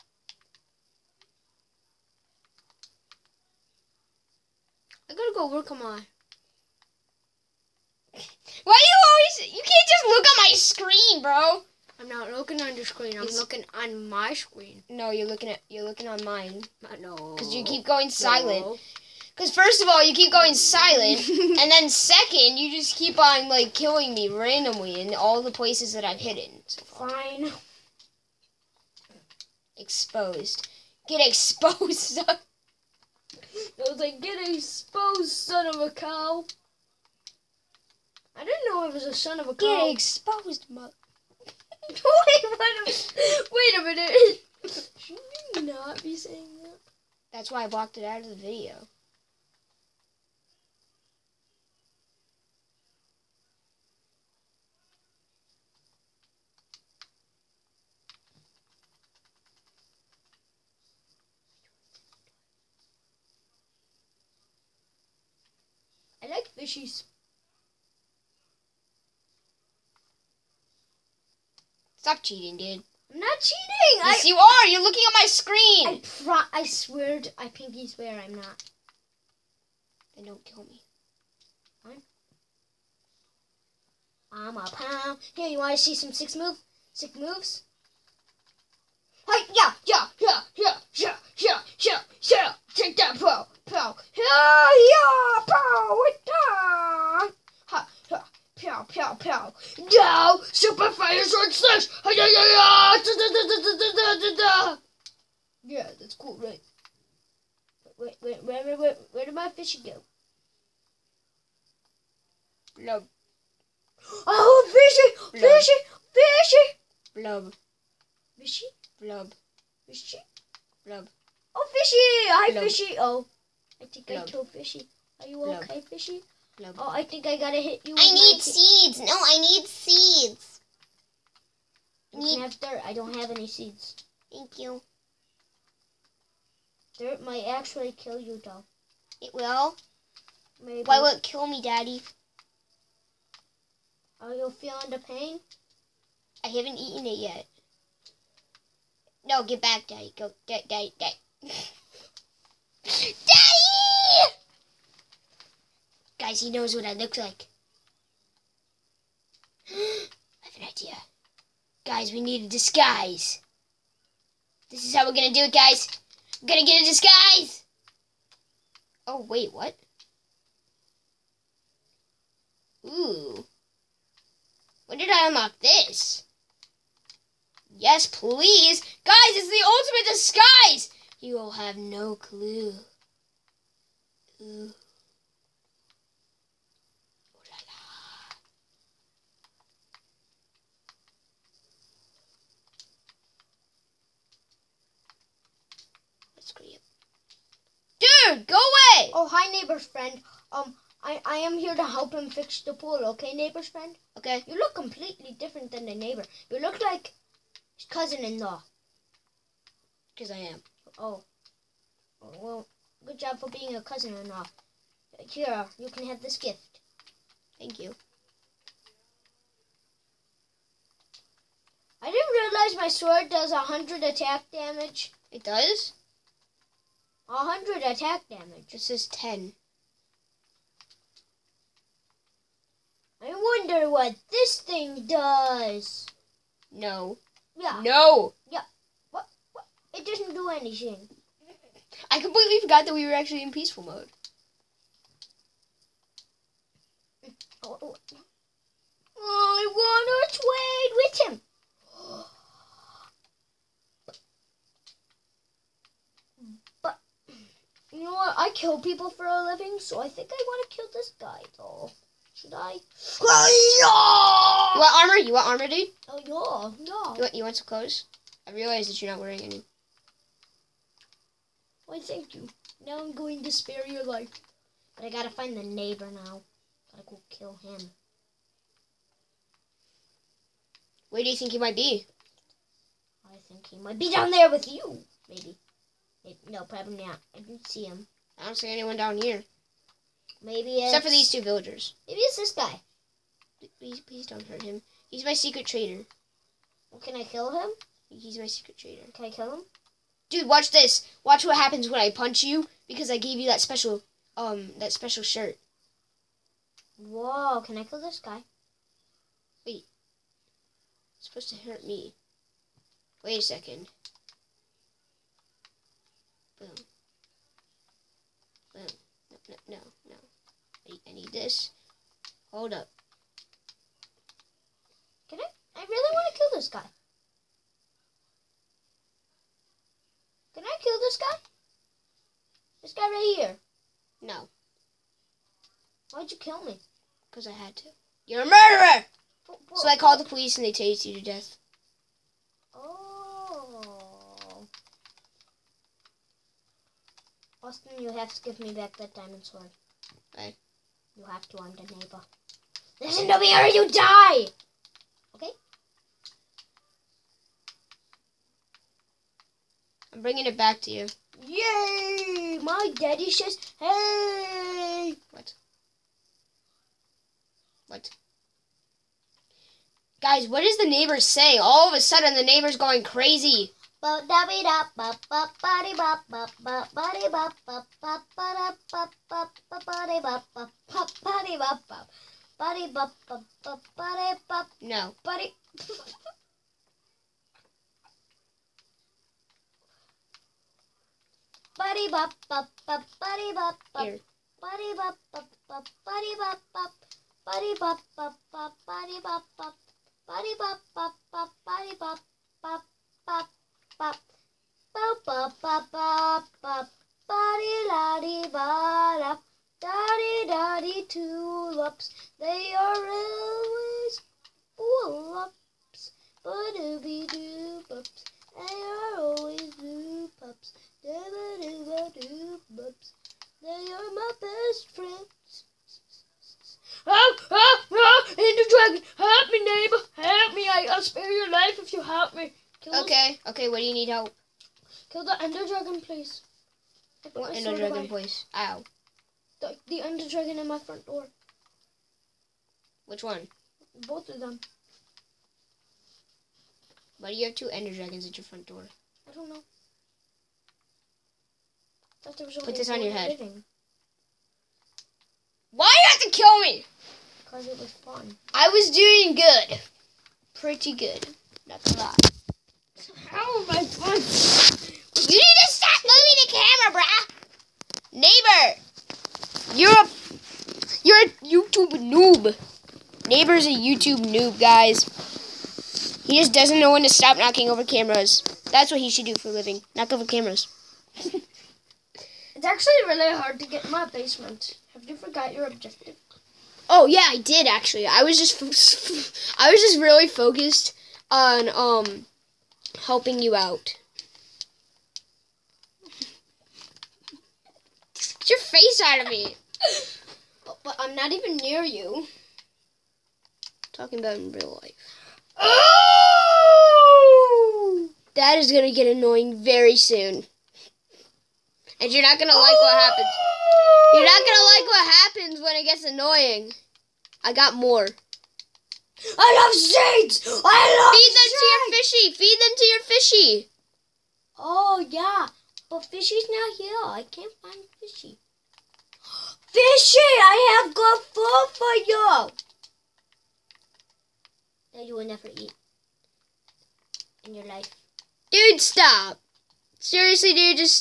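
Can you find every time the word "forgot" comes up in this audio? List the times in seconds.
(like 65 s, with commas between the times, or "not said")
242 s, 485 s.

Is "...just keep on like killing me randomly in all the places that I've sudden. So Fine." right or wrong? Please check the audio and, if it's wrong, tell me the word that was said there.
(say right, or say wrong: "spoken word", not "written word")
wrong: "hidden", not "sudden".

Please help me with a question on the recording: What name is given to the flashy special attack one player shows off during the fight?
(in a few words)
Super fire sword slash.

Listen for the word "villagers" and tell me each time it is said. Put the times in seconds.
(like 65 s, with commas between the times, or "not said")
291 s.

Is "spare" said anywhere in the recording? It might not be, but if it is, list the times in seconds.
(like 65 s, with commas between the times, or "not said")
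273 s, 431 s.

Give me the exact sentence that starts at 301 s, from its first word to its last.
Watch what happens when I punch you because I gave you that special um that special shirt.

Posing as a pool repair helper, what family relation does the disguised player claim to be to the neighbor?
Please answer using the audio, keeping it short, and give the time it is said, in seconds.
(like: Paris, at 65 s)
Cousin-in-law, at 207 s.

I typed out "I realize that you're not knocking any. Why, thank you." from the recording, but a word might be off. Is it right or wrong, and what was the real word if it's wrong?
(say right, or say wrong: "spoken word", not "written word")
wrong: "wearing", not "knocking".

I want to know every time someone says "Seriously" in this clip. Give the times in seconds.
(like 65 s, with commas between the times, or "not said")
539 s.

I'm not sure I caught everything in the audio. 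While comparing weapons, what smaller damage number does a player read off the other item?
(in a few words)
10.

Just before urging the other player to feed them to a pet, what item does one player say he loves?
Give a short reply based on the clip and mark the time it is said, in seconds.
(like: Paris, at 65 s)
Shades, at 519 s.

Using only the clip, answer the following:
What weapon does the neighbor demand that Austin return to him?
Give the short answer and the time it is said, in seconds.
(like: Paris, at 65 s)
Diamond sword, at 349 s.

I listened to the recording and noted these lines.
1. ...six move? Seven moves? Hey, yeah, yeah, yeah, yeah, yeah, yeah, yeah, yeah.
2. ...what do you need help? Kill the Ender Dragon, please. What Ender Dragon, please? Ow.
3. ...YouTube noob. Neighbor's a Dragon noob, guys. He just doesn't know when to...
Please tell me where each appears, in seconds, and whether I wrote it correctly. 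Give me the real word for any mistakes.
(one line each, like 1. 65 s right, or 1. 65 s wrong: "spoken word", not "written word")
1. 86 s wrong: "Six", not "Seven"
2. 433 s right
3. 471 s wrong: "YouTube", not "Dragon".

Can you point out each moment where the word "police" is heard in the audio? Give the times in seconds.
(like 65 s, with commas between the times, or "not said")
340 s.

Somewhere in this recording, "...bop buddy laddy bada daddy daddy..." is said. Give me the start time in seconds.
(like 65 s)
406 s.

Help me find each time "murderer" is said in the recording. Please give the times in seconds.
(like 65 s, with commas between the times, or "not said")
338 s.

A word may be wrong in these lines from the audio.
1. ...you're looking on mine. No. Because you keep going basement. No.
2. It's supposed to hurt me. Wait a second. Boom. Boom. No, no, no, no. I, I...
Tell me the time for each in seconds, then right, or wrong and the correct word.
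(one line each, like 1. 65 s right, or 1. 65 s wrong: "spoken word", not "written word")
1. 15 s wrong: "silent", not "basement"
2. 311 s right.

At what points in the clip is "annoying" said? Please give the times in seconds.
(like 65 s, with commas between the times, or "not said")
509 s, 516 s.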